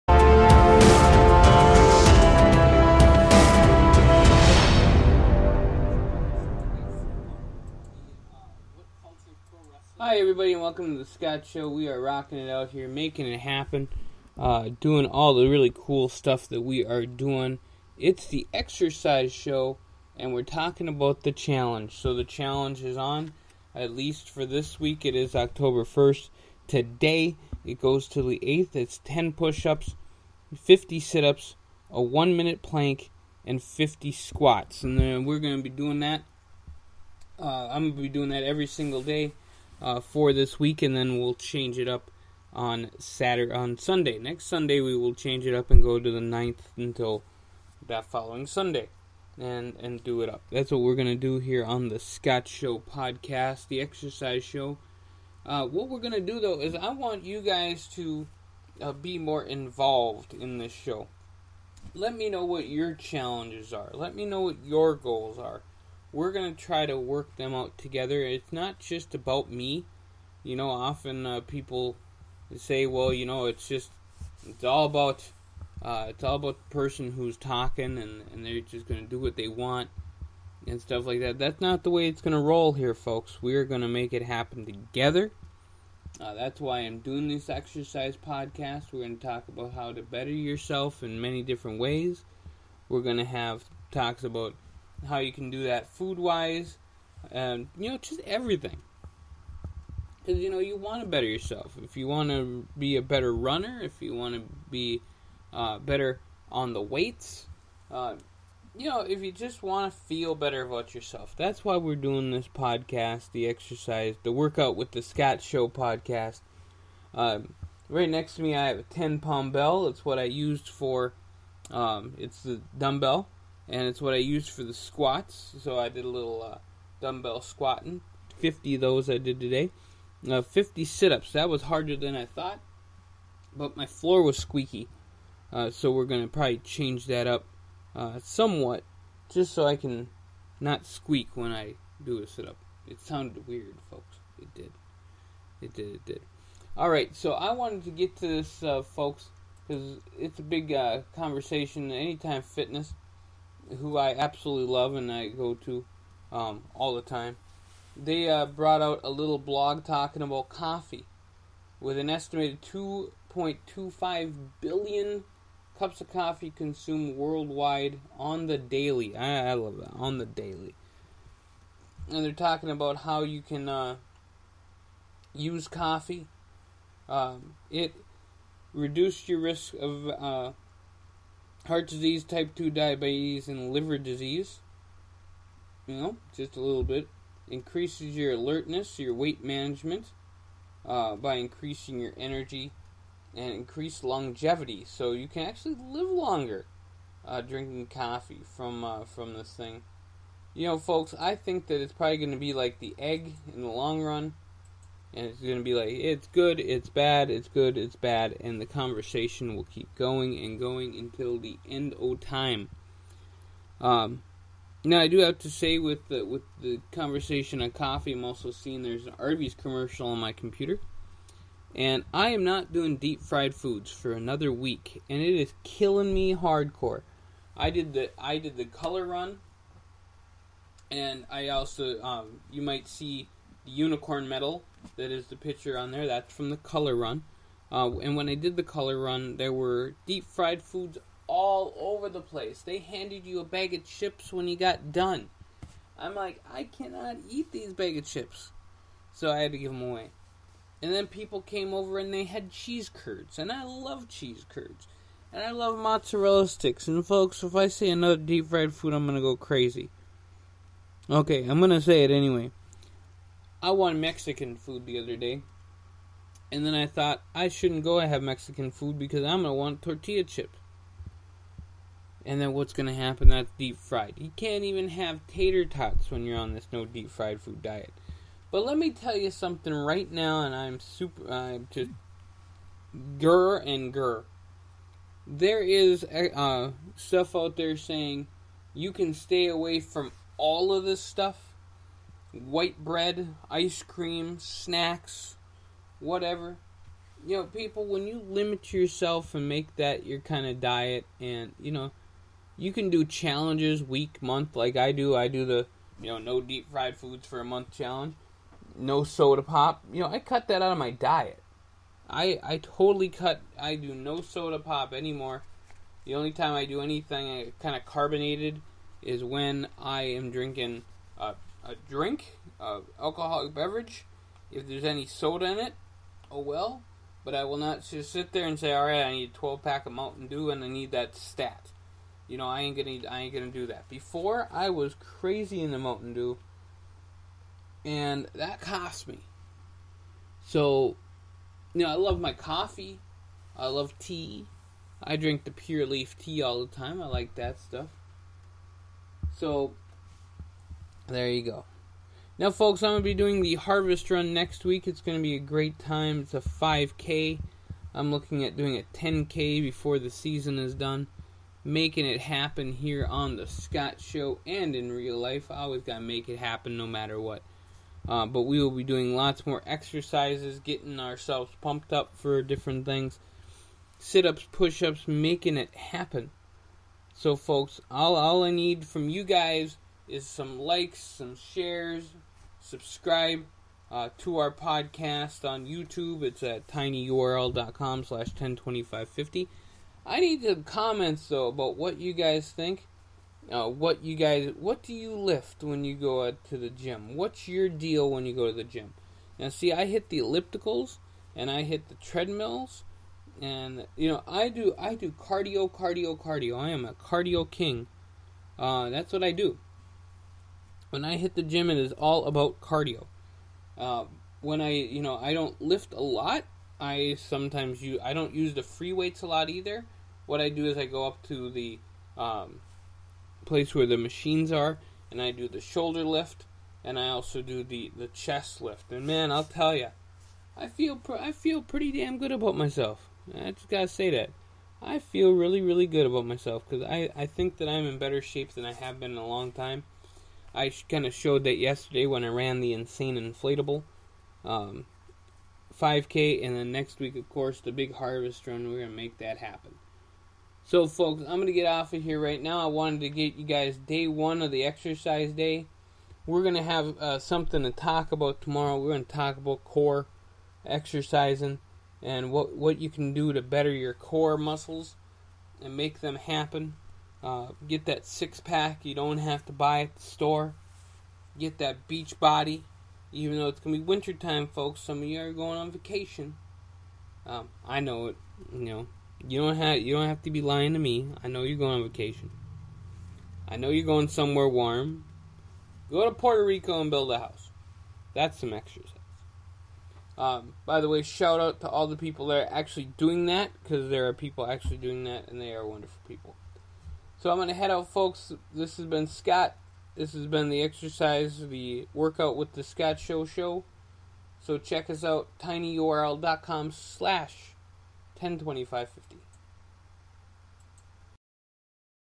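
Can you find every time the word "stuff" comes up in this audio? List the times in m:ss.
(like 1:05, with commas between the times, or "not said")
0:16, 1:20, 4:46, 4:50, 5:47.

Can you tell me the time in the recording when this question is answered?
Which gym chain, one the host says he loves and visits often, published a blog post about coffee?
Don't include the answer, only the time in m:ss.
2:31.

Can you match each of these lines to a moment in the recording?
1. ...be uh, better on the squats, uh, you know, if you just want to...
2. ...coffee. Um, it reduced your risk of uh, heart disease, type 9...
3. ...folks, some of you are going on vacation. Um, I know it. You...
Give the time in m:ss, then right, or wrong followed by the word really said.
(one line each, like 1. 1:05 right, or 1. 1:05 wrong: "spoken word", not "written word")
1. 1:44 wrong: "weights", not "squats"
2. 2:55 wrong: "2", not "9"
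3. 7:54 right.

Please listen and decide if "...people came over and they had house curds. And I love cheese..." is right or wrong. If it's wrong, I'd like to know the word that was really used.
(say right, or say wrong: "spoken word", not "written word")
wrong: "cheese", not "house".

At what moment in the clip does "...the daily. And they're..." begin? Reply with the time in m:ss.
2:50.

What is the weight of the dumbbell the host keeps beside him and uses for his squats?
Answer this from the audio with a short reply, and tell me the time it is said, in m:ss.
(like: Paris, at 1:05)
10 pounds, at 1:58.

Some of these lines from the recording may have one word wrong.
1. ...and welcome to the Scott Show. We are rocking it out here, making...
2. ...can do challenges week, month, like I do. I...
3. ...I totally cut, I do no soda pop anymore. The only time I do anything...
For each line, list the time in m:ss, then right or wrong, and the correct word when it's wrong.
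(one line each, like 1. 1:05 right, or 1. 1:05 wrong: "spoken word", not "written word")
1. 0:10 right
2. 5:02 right
3. 5:12 right.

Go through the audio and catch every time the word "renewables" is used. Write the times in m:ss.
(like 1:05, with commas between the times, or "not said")
not said.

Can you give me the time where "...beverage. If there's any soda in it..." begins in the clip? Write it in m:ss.
5:23.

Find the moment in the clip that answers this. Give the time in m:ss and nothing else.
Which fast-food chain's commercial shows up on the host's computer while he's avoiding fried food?
3:39.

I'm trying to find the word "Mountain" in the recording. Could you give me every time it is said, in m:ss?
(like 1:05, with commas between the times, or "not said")
5:29, 5:35.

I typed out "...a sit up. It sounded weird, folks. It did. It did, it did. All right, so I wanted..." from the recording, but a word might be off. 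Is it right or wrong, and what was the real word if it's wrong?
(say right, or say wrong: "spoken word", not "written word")
right.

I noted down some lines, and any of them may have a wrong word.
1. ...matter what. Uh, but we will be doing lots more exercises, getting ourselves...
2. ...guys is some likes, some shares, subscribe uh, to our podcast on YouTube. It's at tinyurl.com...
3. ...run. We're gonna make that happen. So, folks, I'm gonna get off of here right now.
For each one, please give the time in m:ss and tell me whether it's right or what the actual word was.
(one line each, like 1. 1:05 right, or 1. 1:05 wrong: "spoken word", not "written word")
1. 6:06 right
2. 6:19 right
3. 7:28 right.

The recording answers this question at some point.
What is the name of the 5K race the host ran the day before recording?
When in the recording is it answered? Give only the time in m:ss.
7:22.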